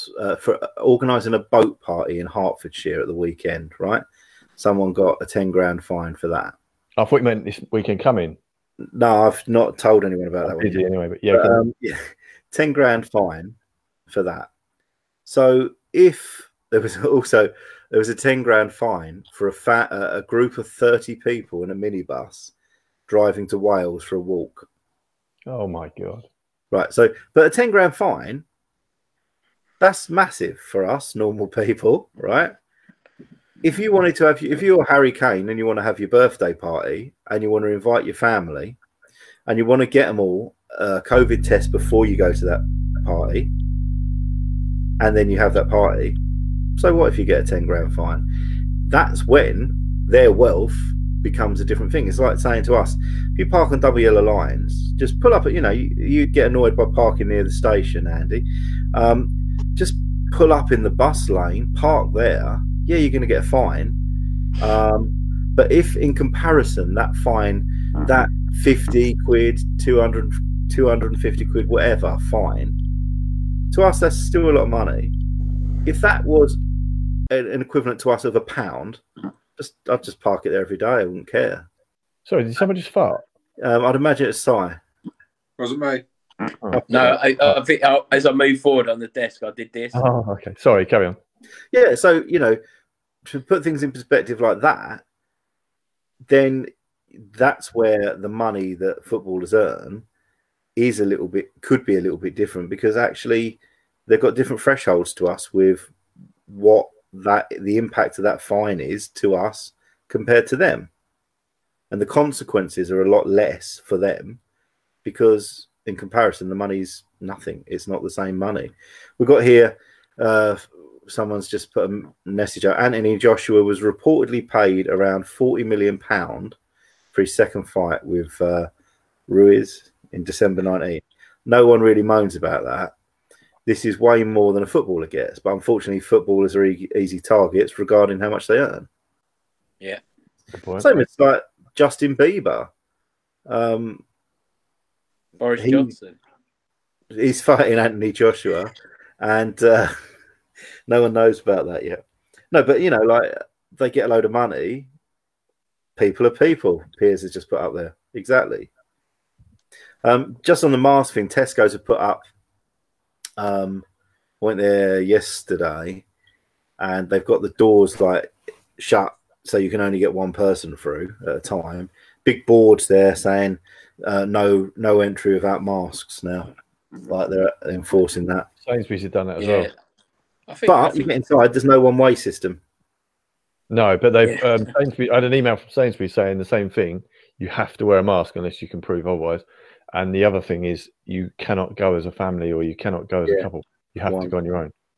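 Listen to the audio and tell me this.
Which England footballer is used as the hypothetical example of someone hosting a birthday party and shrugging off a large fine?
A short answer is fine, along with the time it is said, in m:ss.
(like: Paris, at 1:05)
Harry Kane, at 0:34.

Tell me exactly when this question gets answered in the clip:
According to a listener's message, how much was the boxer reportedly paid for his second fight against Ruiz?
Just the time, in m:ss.
2:05.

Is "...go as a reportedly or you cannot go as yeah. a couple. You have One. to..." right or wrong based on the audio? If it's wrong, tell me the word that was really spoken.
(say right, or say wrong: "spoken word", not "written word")
wrong: "family", not "reportedly".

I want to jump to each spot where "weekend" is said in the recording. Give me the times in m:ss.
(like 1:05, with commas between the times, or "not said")
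0:03, 0:07.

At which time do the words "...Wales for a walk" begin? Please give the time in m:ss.
0:23.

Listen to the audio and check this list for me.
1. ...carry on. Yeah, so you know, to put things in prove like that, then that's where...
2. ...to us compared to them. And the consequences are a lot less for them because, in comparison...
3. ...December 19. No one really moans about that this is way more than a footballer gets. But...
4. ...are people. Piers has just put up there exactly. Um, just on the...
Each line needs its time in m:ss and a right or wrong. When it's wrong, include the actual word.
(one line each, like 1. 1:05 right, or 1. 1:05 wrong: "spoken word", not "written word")
1. 1:30 wrong: "perspective", not "prove"
2. 1:49 right
3. 2:10 right
4. 2:36 right.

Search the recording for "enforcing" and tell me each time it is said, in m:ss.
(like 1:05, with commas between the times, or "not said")
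2:57.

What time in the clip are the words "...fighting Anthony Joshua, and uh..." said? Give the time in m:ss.
2:27.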